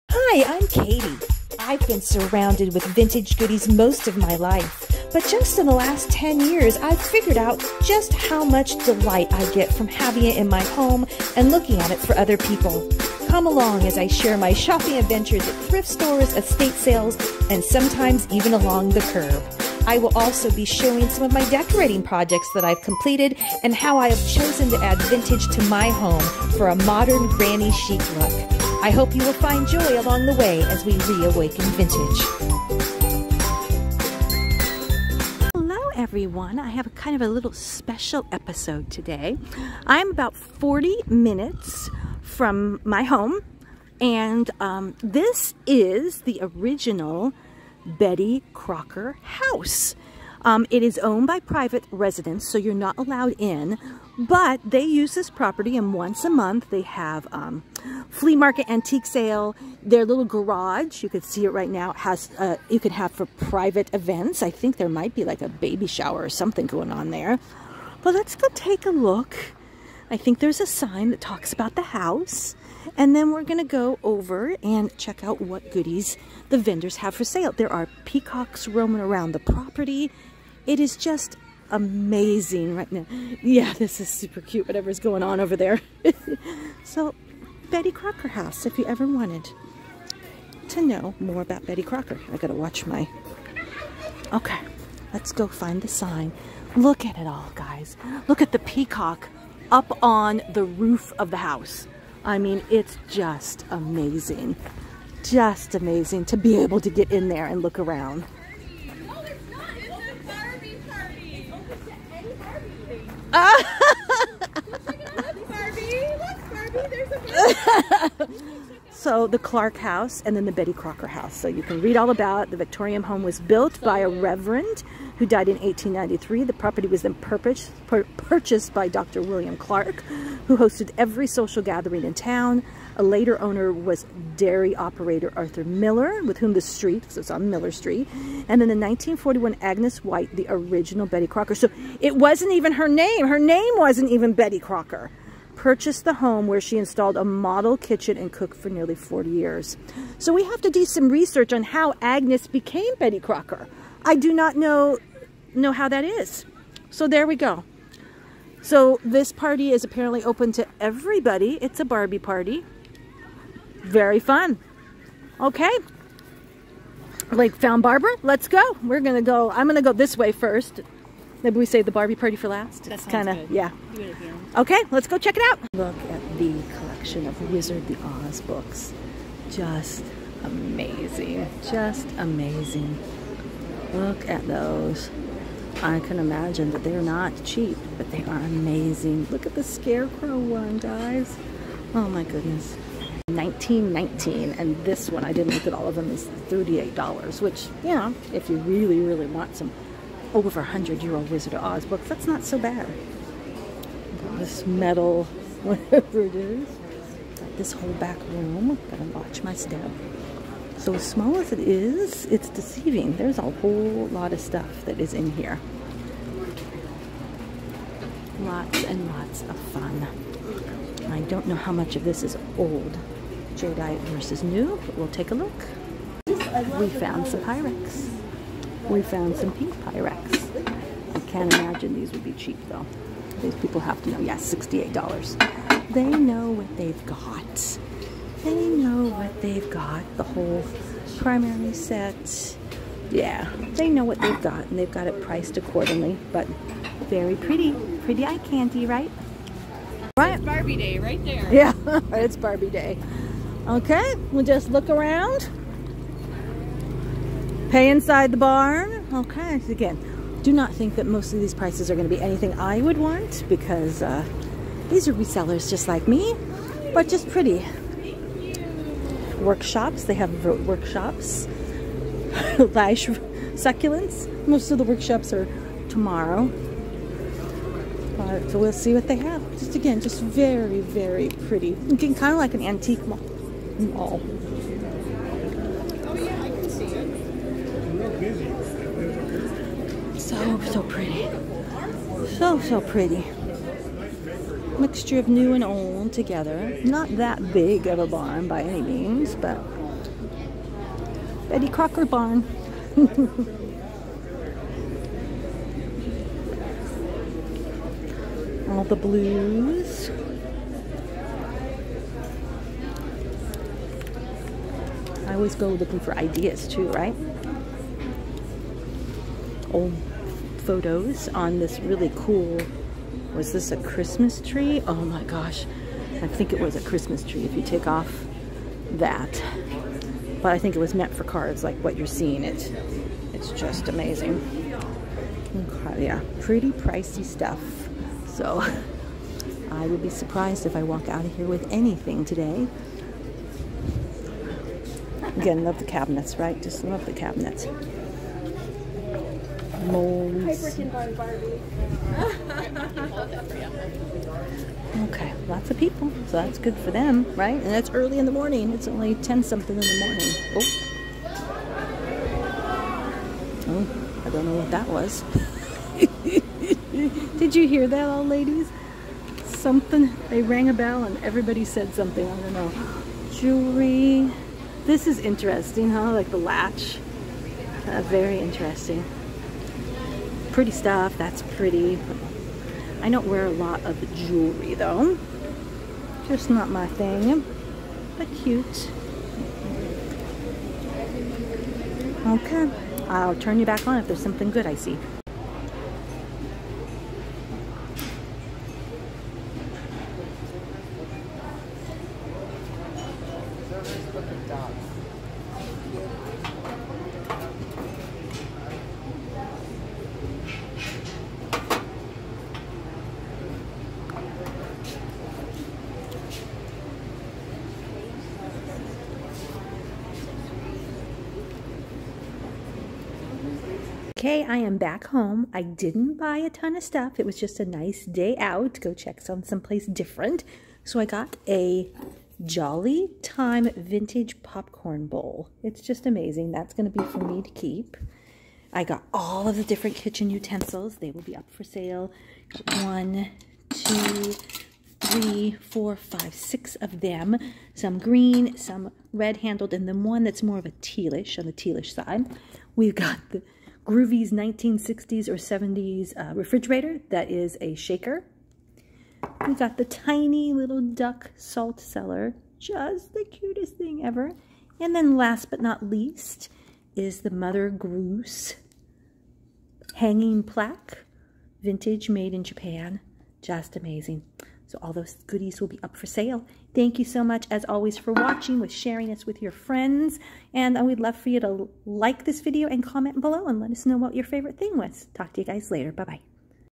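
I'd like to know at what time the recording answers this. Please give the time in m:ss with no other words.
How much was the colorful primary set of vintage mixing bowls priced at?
3:54.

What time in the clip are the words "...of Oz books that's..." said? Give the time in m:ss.
3:21.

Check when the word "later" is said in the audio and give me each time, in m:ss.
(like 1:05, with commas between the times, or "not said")
2:13, 8:05.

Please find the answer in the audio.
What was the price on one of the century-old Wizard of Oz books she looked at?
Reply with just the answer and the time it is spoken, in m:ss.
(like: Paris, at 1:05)
$38, at 3:16.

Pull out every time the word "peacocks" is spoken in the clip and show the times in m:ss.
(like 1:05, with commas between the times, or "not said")
1:18, 1:38.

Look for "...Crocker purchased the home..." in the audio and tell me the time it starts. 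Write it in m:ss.
2:24.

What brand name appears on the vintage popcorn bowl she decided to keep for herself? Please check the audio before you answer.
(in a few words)
Jolly Time.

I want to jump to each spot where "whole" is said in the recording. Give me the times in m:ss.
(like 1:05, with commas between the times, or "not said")
3:27, 3:33, 4:00.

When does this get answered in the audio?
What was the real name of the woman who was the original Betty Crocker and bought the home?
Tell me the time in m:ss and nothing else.
2:19.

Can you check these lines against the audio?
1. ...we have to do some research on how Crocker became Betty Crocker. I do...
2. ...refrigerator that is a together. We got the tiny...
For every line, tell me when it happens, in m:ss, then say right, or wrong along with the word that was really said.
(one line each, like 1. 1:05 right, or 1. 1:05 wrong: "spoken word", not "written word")
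1. 2:30 wrong: "Agnes", not "Crocker"
2. 7:36 wrong: "shaker", not "together".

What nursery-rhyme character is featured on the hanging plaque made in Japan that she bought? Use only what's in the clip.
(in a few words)
Mother Goose.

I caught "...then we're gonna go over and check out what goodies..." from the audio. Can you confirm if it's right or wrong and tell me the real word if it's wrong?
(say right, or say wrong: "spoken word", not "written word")
right.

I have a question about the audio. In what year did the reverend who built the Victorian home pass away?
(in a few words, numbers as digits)
1893.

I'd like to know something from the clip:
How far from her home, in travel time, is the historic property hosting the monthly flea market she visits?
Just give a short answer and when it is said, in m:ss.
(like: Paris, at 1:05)
40 minutes, at 0:40.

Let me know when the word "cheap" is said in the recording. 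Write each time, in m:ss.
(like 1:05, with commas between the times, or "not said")
3:07, 3:52.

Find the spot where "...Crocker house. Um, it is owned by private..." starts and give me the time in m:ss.
0:48.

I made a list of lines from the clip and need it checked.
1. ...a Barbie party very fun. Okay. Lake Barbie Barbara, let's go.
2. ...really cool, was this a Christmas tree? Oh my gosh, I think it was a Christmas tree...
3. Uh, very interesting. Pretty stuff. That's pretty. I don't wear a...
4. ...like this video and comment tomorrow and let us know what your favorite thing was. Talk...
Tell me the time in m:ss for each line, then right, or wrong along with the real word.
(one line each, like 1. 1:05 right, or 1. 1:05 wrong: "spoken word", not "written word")
1. 2:41 wrong: "Found", not "Barbie"
2. 5:21 right
3. 6:17 right
4. 8:01 wrong: "below", not "tomorrow".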